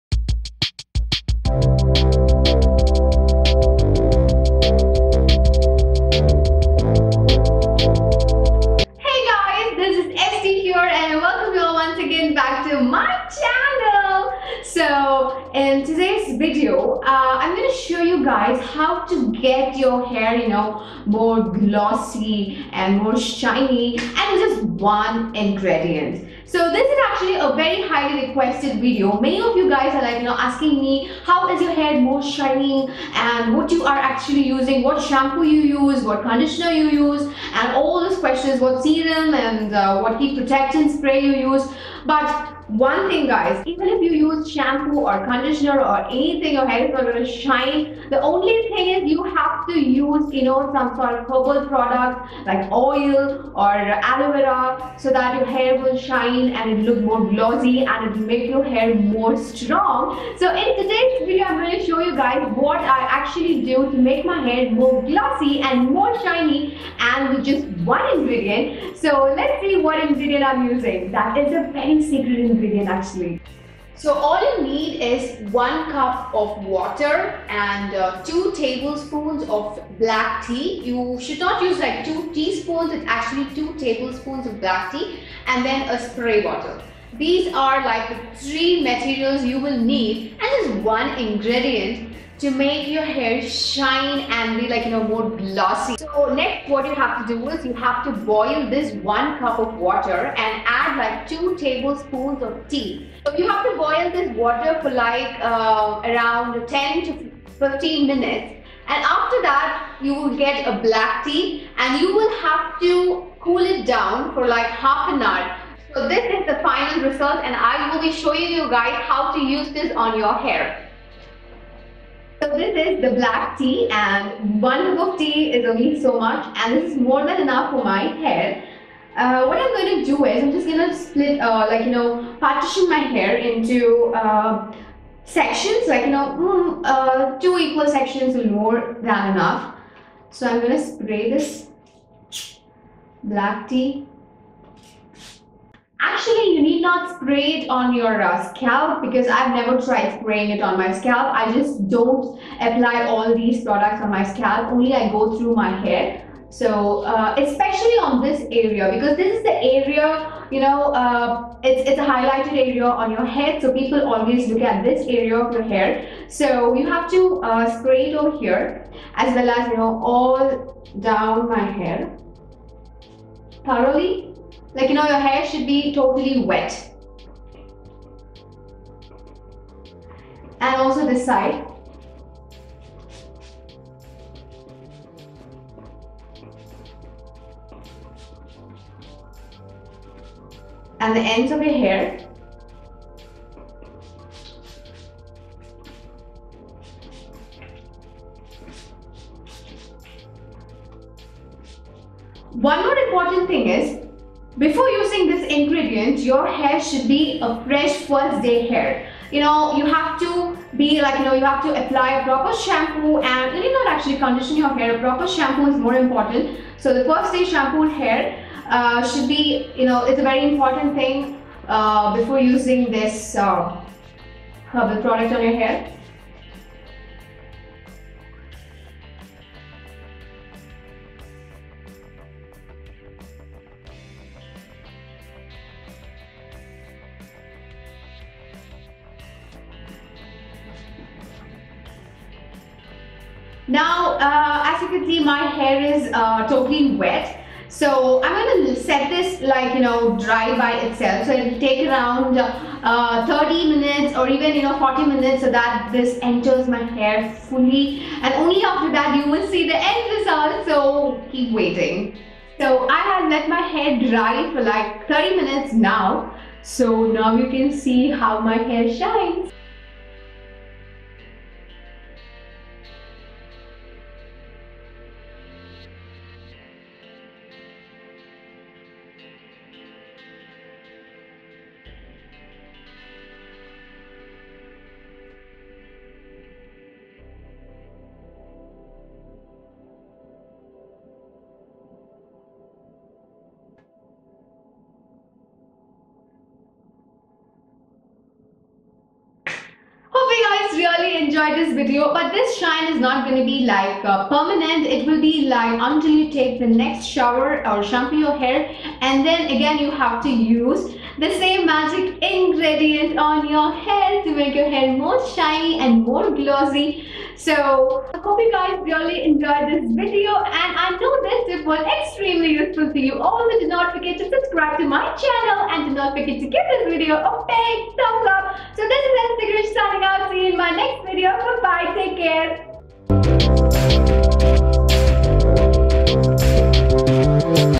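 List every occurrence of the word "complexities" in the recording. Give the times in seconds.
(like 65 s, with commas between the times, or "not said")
not said.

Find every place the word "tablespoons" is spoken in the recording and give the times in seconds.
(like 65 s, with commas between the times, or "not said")
78 s, 83 s, 101 s.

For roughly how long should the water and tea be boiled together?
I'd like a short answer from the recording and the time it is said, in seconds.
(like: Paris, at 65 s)
10 to 15 minutes, at 106 s.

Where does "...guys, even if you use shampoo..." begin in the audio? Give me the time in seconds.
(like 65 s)
43 s.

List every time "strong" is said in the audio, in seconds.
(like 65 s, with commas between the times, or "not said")
59 s.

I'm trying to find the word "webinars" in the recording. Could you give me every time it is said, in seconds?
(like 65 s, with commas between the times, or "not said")
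not said.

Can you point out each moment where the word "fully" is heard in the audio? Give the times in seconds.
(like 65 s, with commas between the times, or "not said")
257 s.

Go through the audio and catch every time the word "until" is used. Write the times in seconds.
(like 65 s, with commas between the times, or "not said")
305 s.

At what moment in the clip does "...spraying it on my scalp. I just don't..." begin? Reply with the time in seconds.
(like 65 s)
150 s.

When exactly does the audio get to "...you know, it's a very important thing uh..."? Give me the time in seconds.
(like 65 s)
219 s.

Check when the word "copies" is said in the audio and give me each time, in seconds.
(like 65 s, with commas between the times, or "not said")
not said.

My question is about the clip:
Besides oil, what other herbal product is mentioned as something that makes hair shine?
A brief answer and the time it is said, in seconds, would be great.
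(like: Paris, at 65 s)
aloe vera, at 53 s.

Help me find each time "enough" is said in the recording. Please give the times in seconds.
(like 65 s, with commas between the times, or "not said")
127 s, 139 s.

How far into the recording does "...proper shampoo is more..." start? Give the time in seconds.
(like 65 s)
214 s.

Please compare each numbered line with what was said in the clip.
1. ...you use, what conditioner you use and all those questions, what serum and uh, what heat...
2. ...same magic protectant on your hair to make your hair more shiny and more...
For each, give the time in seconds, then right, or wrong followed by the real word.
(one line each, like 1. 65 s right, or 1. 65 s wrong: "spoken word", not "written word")
1. 35 s right
2. 311 s wrong: "ingredient", not "protectant".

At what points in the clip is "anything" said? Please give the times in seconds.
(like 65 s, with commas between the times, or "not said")
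46 s.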